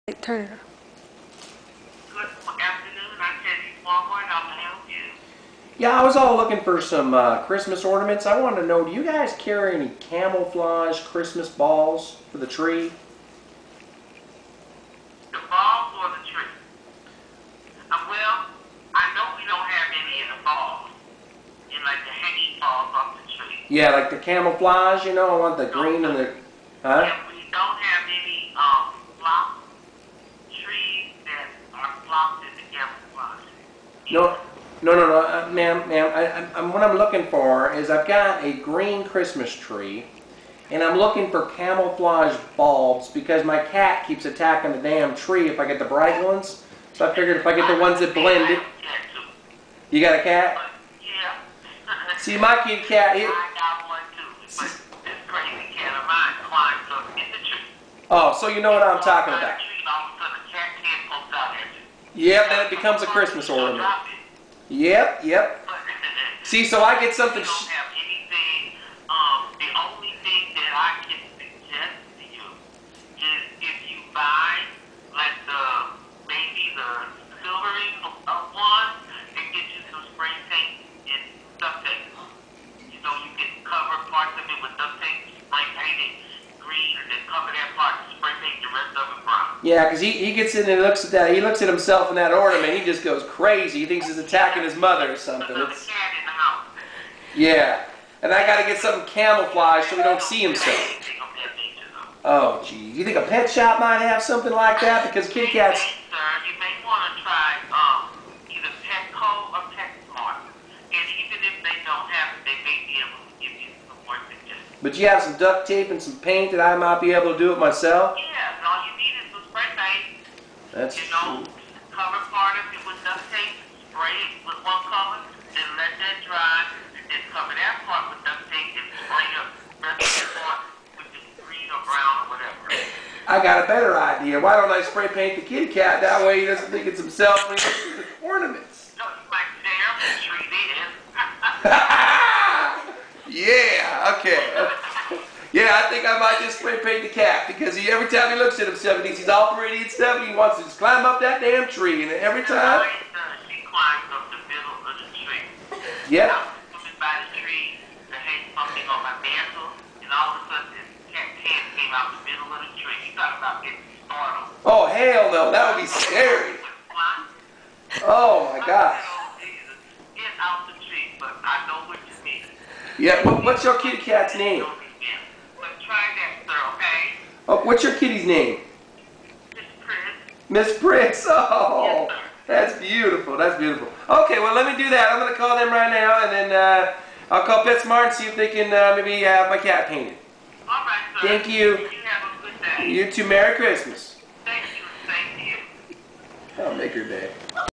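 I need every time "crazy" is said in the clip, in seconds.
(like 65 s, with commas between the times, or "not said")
55 s, 93 s.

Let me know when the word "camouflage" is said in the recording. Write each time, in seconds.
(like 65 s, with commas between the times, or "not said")
9 s, 24 s, 41 s, 99 s.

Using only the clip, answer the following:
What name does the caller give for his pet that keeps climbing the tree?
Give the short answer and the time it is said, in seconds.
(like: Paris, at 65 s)
Miss Prince, at 180 s.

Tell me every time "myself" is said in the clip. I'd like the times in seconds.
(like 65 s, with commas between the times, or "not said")
117 s.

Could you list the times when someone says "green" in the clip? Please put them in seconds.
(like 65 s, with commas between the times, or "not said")
25 s, 38 s, 131 s.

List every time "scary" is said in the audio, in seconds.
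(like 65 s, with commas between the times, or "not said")
165 s.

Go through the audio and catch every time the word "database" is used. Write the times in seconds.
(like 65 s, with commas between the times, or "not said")
not said.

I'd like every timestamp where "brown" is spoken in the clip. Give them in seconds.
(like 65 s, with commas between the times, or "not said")
89 s, 131 s.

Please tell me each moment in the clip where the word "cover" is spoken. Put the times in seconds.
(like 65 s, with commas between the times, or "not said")
121 s, 127 s.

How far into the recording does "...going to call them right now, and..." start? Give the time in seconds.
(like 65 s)
185 s.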